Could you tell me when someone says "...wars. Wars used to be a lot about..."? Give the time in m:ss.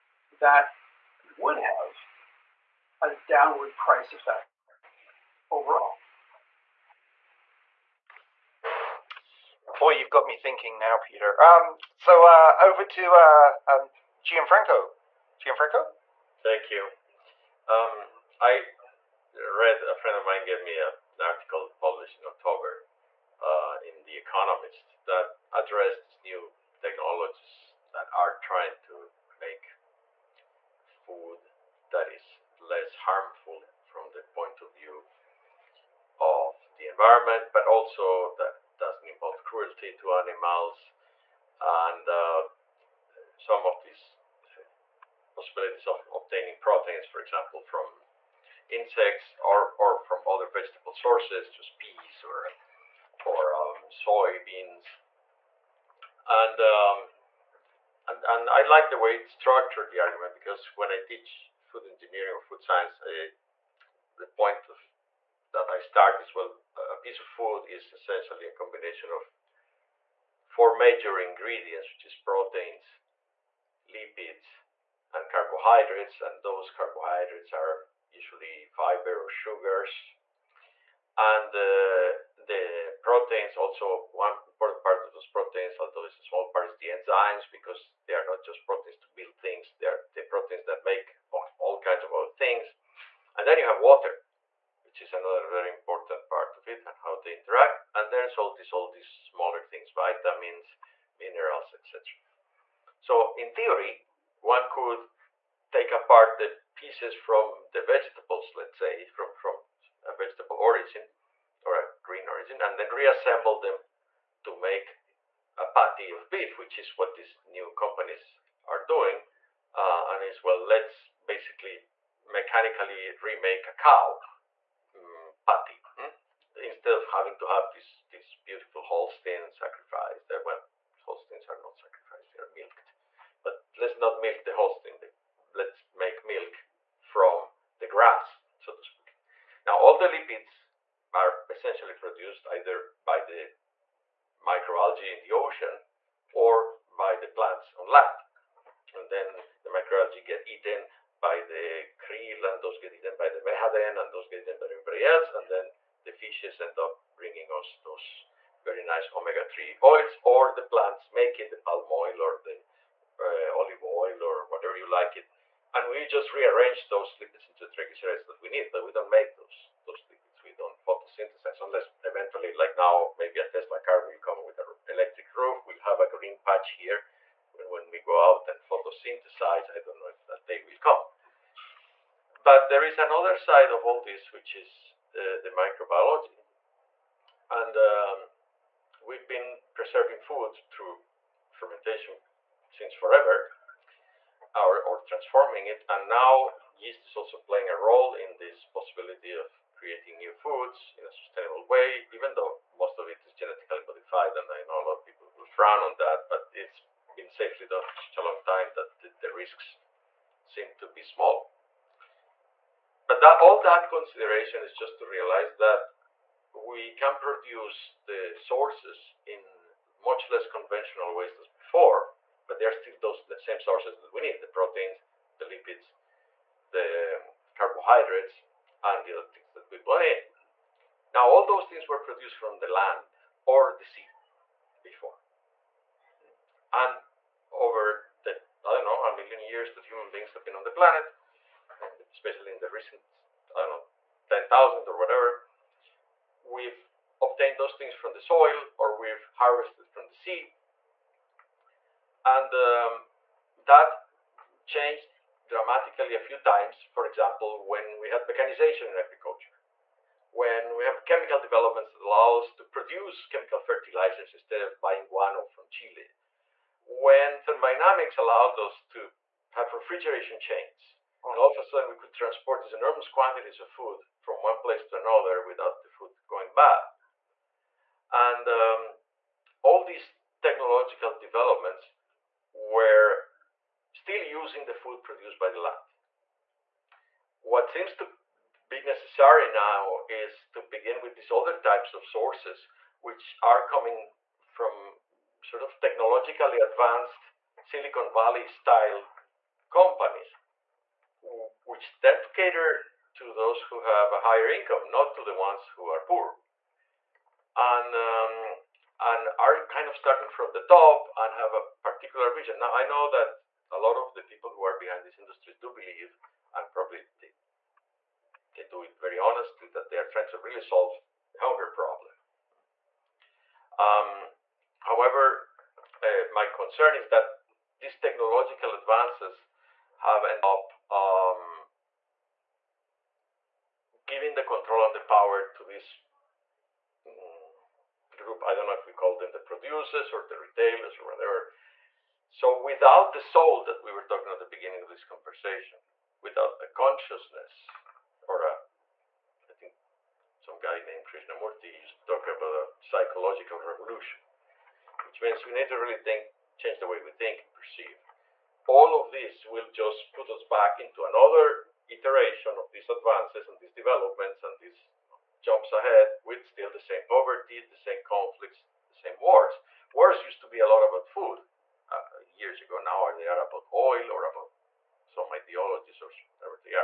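6:09.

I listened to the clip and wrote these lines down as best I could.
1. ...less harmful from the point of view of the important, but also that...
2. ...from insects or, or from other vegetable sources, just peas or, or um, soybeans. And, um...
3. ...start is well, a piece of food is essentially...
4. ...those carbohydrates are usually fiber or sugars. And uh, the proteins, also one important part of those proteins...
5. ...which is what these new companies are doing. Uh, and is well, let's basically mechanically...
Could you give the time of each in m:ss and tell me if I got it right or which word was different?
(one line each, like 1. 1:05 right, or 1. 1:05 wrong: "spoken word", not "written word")
1. 0:32 wrong: "environment", not "important"
2. 0:47 right
3. 1:05 right
4. 1:16 right
5. 1:56 right.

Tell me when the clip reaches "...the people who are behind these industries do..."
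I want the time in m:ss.
5:14.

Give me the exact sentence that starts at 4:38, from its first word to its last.
And um, all these technological developments were still using the food produced by the land.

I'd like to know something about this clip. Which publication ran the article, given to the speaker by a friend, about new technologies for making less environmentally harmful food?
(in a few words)
The Economist.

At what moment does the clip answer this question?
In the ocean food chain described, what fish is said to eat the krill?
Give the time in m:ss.
2:33.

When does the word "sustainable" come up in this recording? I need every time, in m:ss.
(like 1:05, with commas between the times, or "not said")
3:21.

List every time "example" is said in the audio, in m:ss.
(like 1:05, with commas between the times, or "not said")
0:47, 4:17.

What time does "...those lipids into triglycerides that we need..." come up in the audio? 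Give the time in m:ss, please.
2:46.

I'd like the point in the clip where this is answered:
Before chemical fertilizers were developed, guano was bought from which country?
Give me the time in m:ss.
4:25.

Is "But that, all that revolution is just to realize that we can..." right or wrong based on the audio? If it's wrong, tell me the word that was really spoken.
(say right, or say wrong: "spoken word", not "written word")
wrong: "consideration", not "revolution".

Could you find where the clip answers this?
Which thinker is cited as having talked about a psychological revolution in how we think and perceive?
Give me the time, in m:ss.
5:51.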